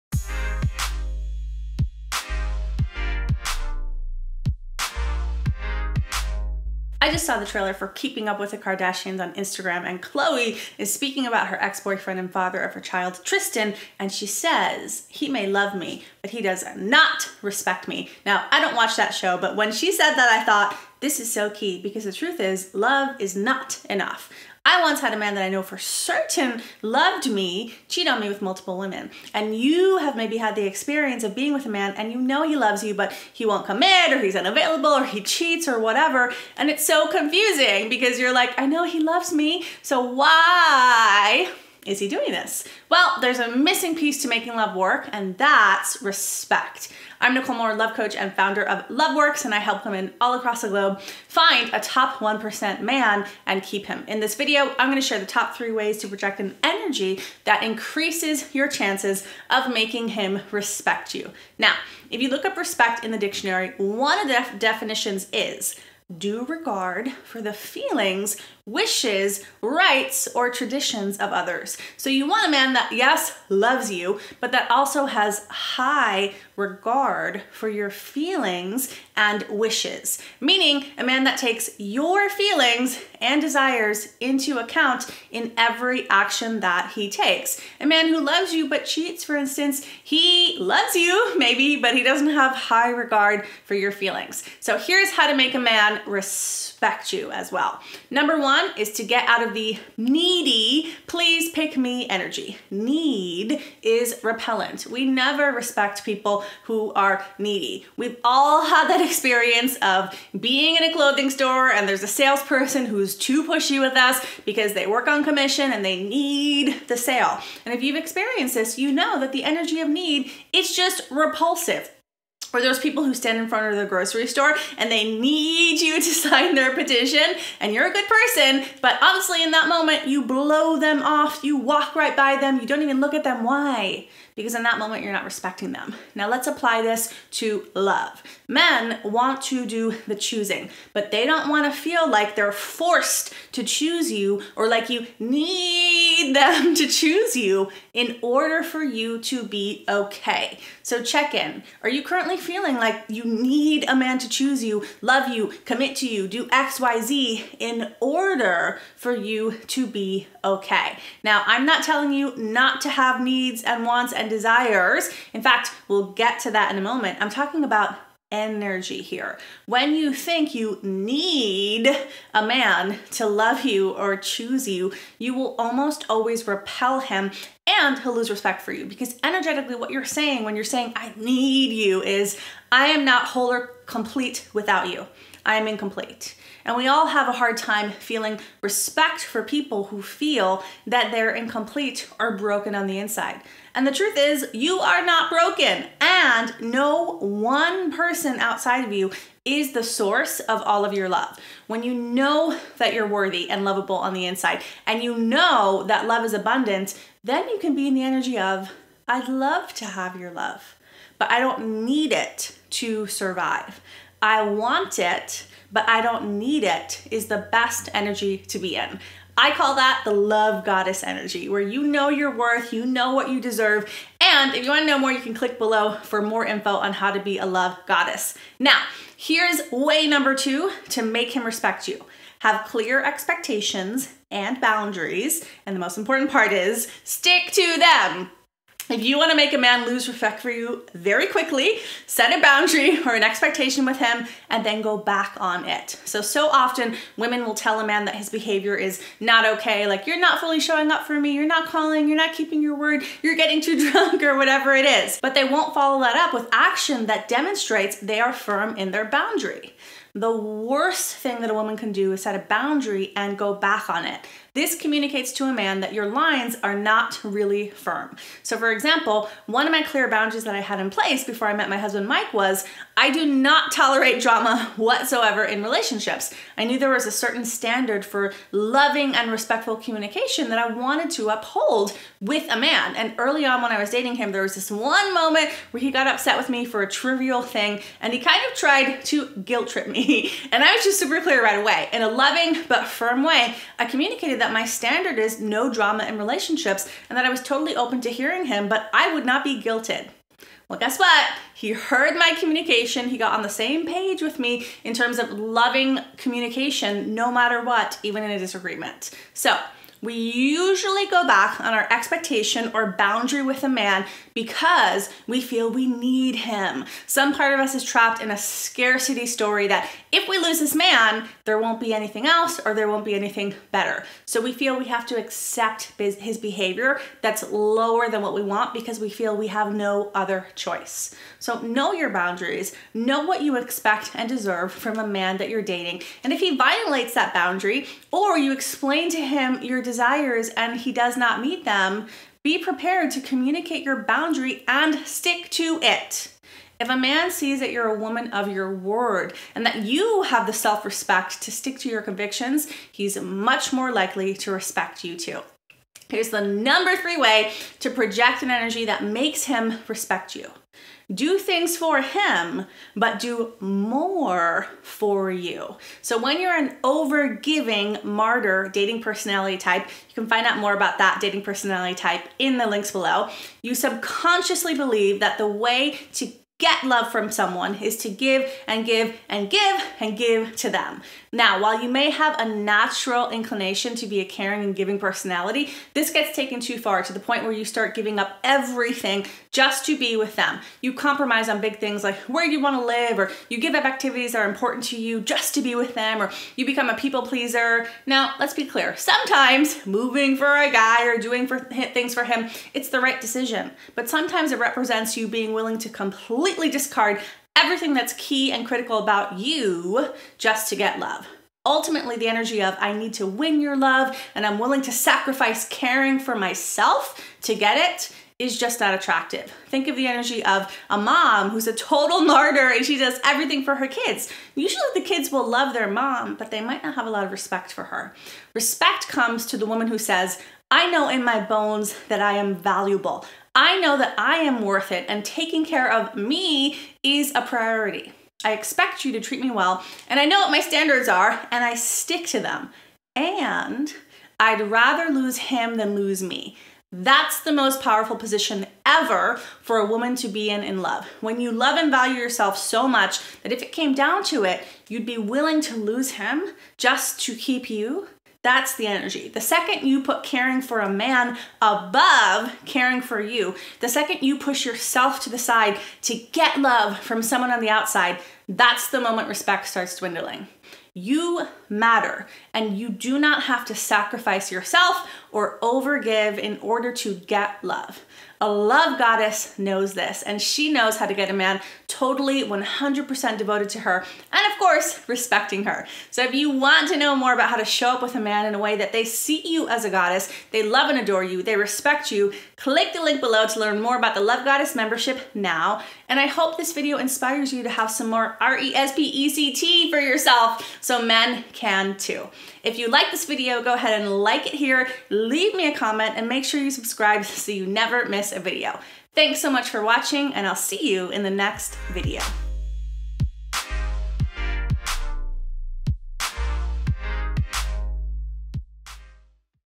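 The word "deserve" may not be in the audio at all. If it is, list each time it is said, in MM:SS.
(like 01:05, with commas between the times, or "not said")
03:43, 05:34.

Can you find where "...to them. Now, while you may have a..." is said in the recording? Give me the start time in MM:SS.
06:20.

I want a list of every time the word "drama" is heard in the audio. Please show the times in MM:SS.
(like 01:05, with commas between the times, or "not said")
04:34, 04:55.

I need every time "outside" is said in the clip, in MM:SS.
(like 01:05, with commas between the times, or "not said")
03:18, 07:47.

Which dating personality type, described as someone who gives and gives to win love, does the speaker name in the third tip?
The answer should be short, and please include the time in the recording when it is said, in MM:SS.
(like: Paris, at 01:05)
over giving martyr, at 06:06.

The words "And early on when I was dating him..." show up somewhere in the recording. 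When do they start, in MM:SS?
04:42.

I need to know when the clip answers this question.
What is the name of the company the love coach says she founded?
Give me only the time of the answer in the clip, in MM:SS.
00:48.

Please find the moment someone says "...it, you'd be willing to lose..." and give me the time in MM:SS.
07:34.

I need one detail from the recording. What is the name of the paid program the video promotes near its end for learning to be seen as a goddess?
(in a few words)
Love Goddess membership.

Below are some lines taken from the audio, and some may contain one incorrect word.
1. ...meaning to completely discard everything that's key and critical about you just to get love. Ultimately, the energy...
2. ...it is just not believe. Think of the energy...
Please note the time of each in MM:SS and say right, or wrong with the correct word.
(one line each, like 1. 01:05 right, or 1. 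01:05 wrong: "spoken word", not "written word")
1. 06:45 wrong: "willing", not "meaning"
2. 06:57 wrong: "attractive", not "believe".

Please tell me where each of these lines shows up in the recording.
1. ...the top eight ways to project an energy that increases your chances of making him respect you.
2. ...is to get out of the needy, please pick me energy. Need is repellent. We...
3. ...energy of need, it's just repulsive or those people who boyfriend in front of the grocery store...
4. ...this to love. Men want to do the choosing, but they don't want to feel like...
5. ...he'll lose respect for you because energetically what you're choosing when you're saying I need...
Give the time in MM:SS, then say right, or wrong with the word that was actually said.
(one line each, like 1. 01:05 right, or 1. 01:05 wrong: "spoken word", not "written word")
1. 00:55 wrong: "three", not "eight"
2. 01:38 right
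3. 01:59 wrong: "stand", not "boyfriend"
4. 02:16 right
5. 02:57 wrong: "saying", not "choosing".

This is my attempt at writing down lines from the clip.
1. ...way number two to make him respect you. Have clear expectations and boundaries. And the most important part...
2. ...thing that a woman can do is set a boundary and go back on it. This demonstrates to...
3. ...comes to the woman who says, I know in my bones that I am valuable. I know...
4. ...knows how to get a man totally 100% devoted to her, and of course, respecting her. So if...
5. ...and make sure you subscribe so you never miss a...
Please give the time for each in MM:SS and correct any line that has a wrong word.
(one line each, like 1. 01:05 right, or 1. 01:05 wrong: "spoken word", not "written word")
1. 03:49 right
2. 04:21 wrong: "communicates", not "demonstrates"
3. 07:09 right
4. 08:00 right
5. 08:26 right.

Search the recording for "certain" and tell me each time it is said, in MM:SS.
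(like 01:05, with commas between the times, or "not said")
00:25, 04:37.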